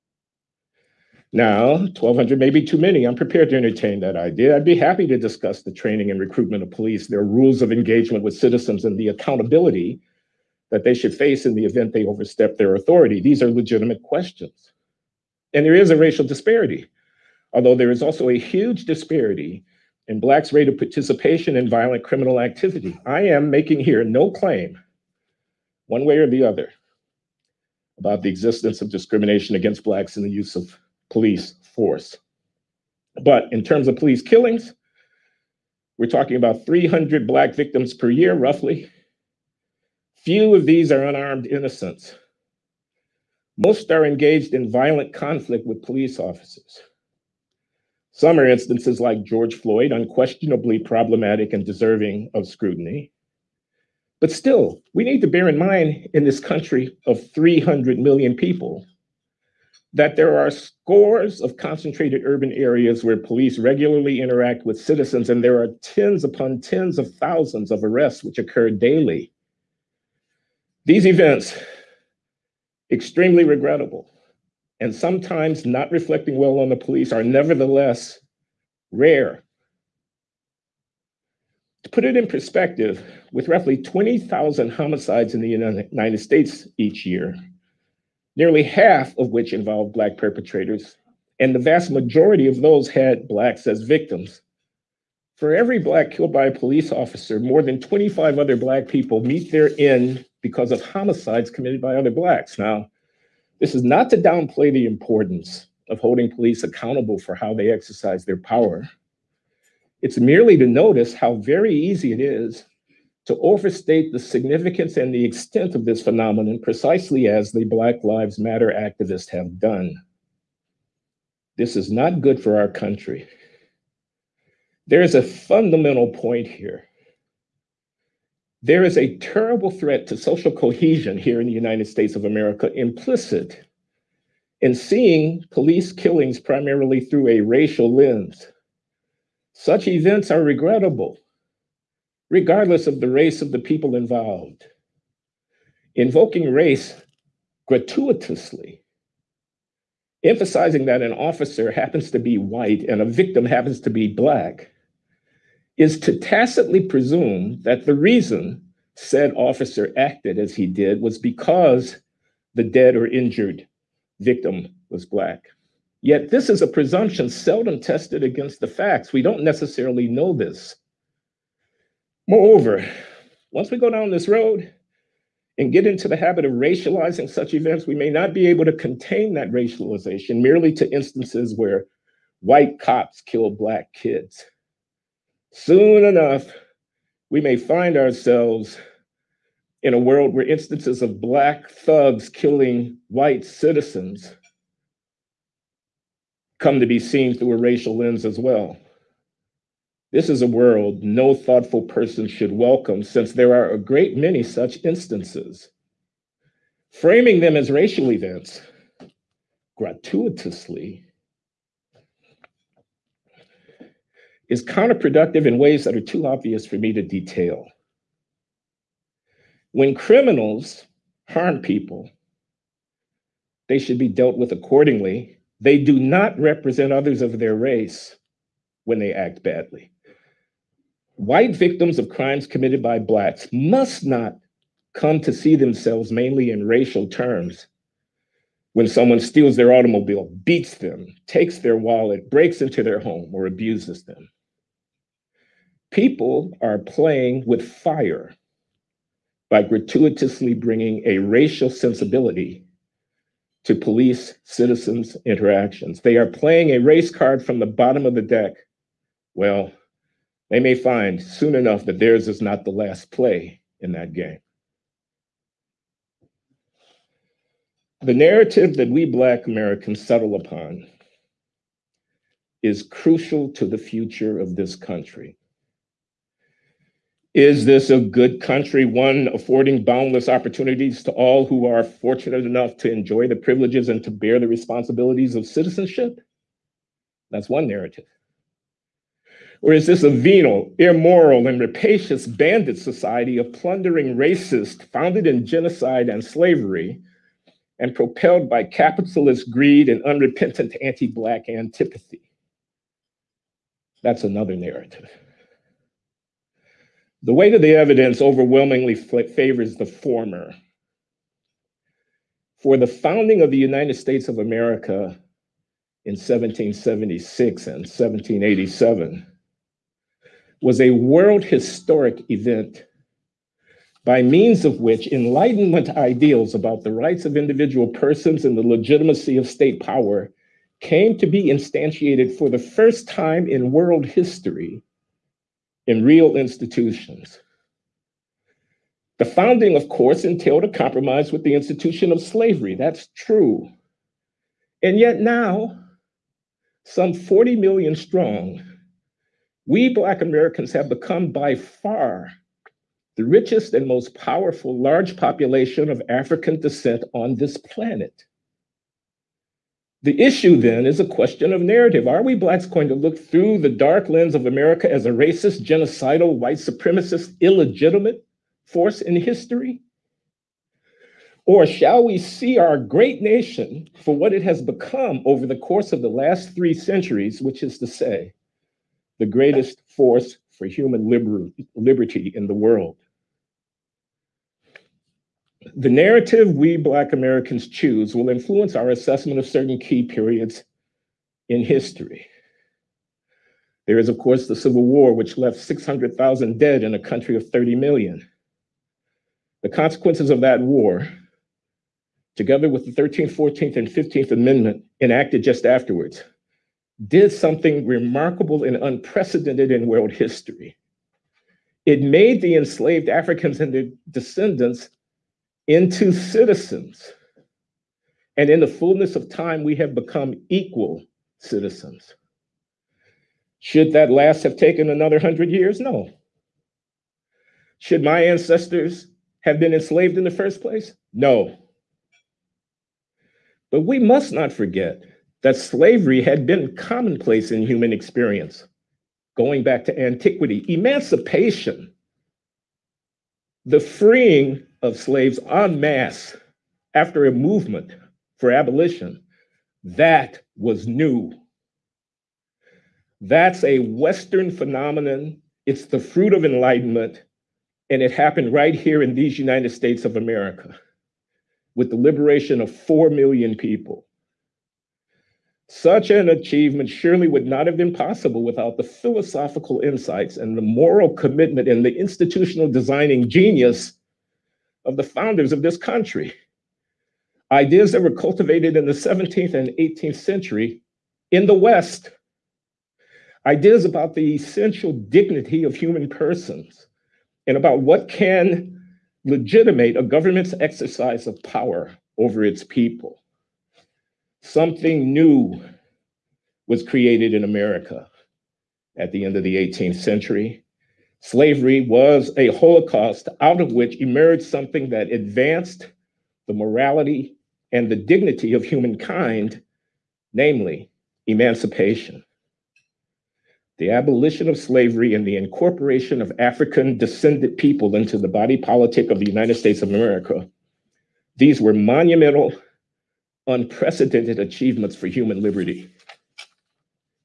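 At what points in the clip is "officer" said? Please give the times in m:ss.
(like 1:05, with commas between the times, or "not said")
0:46, 1:36, 2:31, 2:39.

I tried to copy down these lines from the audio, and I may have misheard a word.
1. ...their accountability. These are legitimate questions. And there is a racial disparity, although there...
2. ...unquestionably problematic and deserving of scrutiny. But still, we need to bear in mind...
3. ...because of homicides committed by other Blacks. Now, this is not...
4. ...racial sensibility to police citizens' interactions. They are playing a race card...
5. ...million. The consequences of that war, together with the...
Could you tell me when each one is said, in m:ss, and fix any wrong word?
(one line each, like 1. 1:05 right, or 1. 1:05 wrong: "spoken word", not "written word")
1. 0:12 wrong: "authority", not "accountability"
2. 0:49 right
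3. 1:40 right
4. 4:11 right
5. 6:37 right.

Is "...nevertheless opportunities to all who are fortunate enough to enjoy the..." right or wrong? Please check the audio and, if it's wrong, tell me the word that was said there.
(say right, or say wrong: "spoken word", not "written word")
wrong: "boundless", not "nevertheless".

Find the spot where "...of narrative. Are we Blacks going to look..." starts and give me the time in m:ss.
6:01.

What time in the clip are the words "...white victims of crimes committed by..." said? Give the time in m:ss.
3:51.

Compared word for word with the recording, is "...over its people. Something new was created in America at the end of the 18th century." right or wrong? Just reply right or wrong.
right.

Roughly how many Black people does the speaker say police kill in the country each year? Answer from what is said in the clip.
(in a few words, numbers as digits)
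300.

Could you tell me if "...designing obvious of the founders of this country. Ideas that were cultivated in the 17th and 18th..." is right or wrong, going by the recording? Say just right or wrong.
wrong.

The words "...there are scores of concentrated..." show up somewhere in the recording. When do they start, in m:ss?
1:00.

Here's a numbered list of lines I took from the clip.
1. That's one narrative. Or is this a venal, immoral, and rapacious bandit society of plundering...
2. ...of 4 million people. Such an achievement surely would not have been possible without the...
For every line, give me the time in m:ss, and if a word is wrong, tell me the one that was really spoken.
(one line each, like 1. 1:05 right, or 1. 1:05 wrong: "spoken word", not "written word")
1. 4:47 right
2. 7:42 right.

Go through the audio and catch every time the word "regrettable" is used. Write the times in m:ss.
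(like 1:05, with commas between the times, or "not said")
1:13, 2:20.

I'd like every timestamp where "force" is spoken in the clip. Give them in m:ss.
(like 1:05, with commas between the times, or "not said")
0:31, 6:08, 6:19.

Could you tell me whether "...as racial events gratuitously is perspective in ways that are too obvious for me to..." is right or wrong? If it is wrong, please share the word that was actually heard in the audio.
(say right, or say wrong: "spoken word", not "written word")
wrong: "counterproductive", not "perspective".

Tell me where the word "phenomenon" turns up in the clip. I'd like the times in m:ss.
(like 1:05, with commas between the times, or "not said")
1:56, 7:34.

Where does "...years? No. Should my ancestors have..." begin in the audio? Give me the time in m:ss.
7:05.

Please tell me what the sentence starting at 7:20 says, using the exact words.
Emancipation, the freeing of slaves en masse after a movement for abolition, that was new.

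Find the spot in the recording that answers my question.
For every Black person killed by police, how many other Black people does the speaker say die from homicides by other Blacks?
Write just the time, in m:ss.
1:37.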